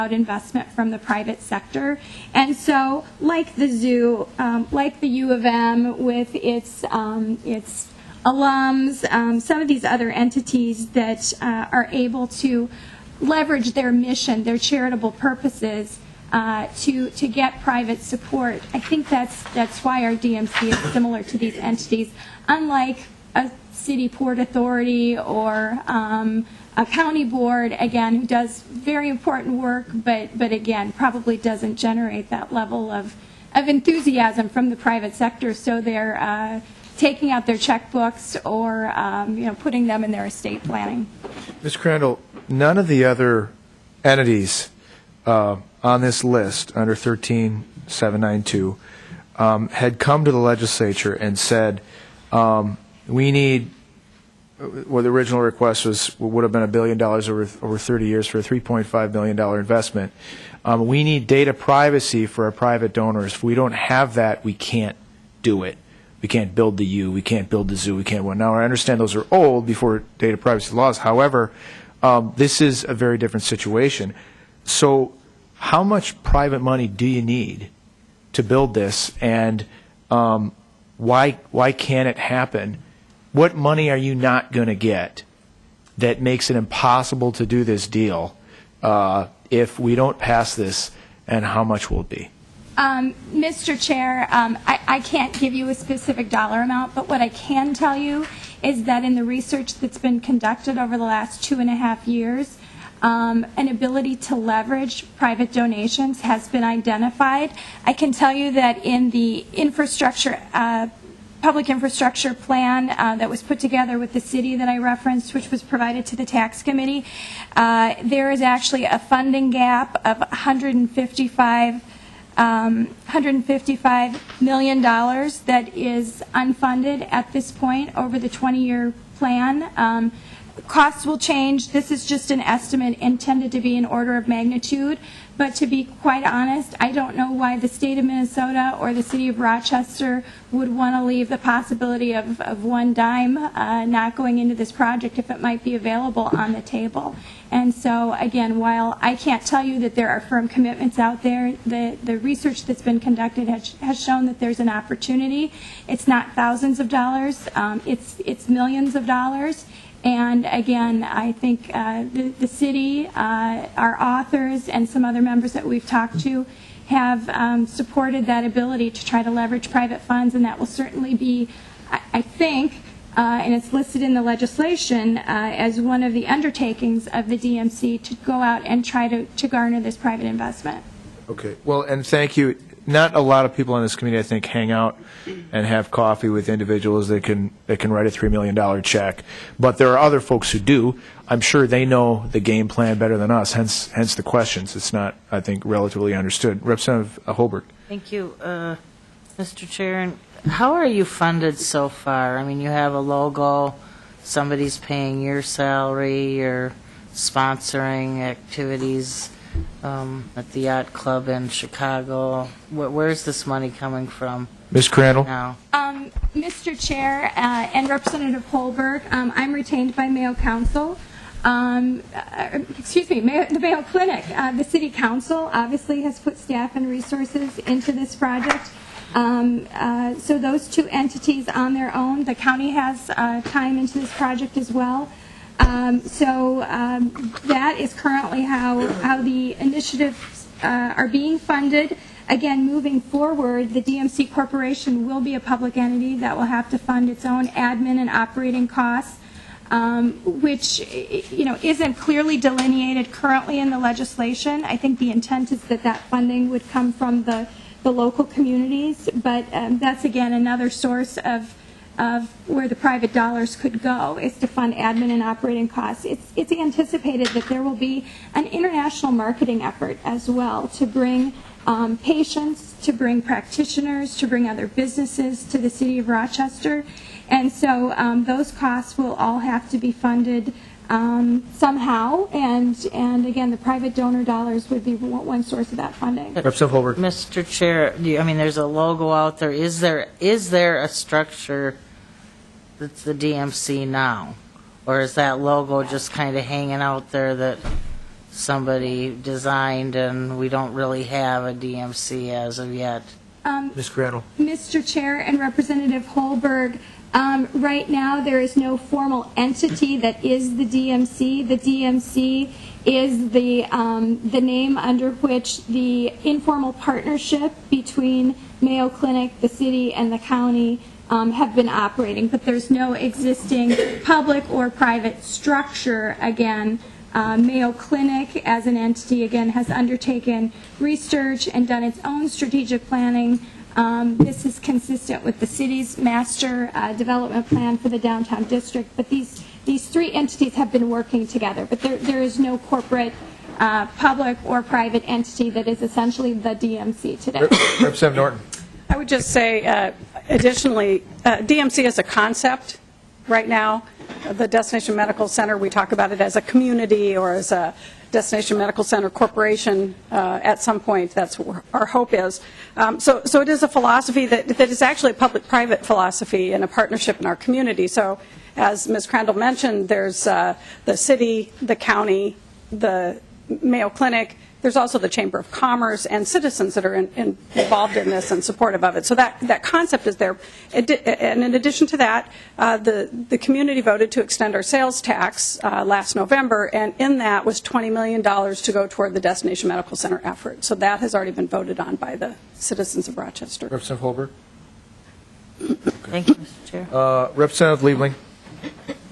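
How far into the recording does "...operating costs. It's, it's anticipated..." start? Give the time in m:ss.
4:25.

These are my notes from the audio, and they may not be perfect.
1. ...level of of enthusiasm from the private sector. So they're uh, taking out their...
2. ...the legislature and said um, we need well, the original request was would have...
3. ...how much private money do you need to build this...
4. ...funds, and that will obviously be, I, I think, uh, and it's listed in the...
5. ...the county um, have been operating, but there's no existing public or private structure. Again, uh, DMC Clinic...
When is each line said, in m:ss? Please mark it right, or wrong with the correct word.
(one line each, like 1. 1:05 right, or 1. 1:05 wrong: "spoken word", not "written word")
1. 0:32 right
2. 0:50 right
3. 1:15 right
4. 2:49 wrong: "certainly", not "obviously"
5. 5:20 wrong: "Mayo", not "DMC".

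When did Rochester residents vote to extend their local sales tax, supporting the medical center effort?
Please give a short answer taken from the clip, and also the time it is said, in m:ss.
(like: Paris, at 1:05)
last November, at 6:25.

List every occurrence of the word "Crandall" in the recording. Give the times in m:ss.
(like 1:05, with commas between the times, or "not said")
0:41, 3:34, 6:09.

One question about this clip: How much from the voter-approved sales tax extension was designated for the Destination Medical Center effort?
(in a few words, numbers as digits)
$20 million.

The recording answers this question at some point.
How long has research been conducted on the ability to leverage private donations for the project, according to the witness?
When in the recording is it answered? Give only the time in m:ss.
1:41.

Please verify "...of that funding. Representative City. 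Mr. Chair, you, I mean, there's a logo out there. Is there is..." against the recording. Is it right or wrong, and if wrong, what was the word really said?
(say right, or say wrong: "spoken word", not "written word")
wrong: "Holberg", not "City".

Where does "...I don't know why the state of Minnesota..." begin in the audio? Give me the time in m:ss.
2:16.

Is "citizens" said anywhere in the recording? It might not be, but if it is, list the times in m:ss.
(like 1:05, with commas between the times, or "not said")
6:16, 6:32.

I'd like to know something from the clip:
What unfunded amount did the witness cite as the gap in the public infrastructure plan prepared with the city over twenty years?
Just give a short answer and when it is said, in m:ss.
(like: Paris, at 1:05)
$155 million, at 2:03.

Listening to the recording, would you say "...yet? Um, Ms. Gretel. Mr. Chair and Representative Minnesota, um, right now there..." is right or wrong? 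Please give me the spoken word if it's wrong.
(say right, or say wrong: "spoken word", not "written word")
wrong: "Holberg", not "Minnesota".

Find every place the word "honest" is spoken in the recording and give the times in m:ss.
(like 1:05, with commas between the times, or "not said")
2:16.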